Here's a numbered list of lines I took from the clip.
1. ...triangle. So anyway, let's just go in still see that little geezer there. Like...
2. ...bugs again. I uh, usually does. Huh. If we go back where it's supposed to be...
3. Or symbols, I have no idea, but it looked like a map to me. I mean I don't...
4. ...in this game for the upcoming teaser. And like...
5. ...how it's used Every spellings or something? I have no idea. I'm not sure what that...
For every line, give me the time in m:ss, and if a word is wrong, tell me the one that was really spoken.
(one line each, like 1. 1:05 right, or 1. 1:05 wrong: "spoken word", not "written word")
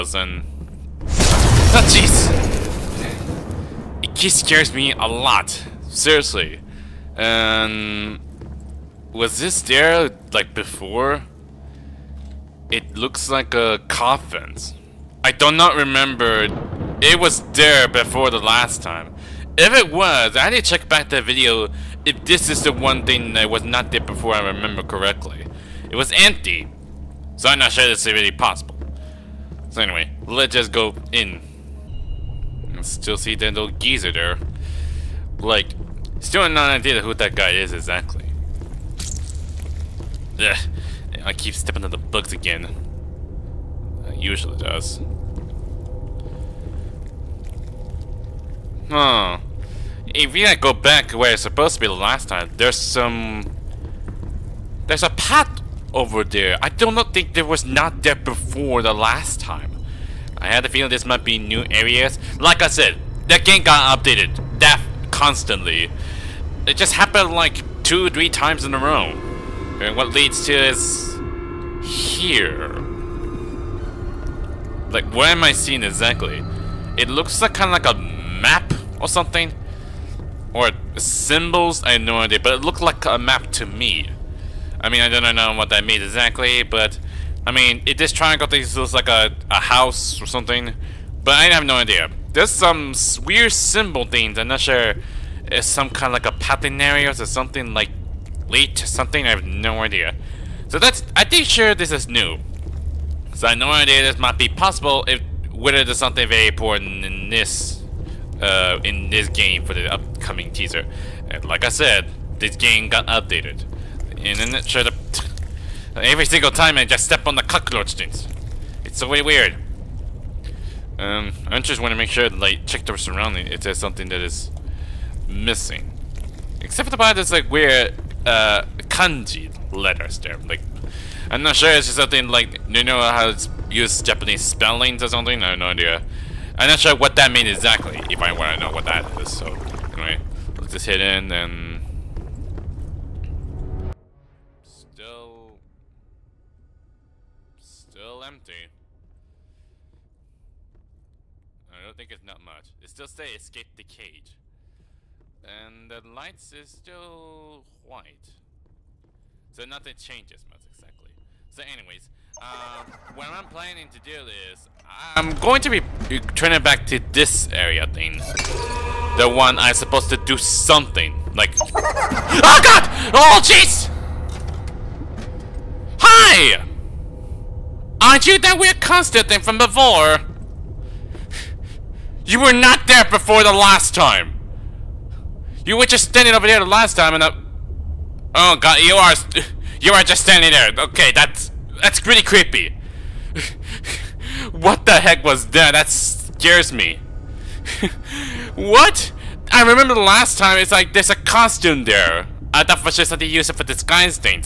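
1. 0:28 wrong: "possible", not "triangle"
2. 0:41 right
3. 1:20 right
4. 1:48 right
5. 2:12 wrong: "Japanese", not "Every".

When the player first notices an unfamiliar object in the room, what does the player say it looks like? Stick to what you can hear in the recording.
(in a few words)
A coffin.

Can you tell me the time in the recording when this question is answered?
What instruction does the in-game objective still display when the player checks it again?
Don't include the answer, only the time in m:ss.
2:33.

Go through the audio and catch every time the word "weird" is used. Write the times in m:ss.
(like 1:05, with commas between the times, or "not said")
1:33, 1:59, 2:07, 2:58.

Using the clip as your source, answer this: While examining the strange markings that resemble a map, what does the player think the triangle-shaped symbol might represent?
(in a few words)
A house.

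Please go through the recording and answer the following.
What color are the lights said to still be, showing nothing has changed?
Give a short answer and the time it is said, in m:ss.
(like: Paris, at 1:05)
White, at 2:37.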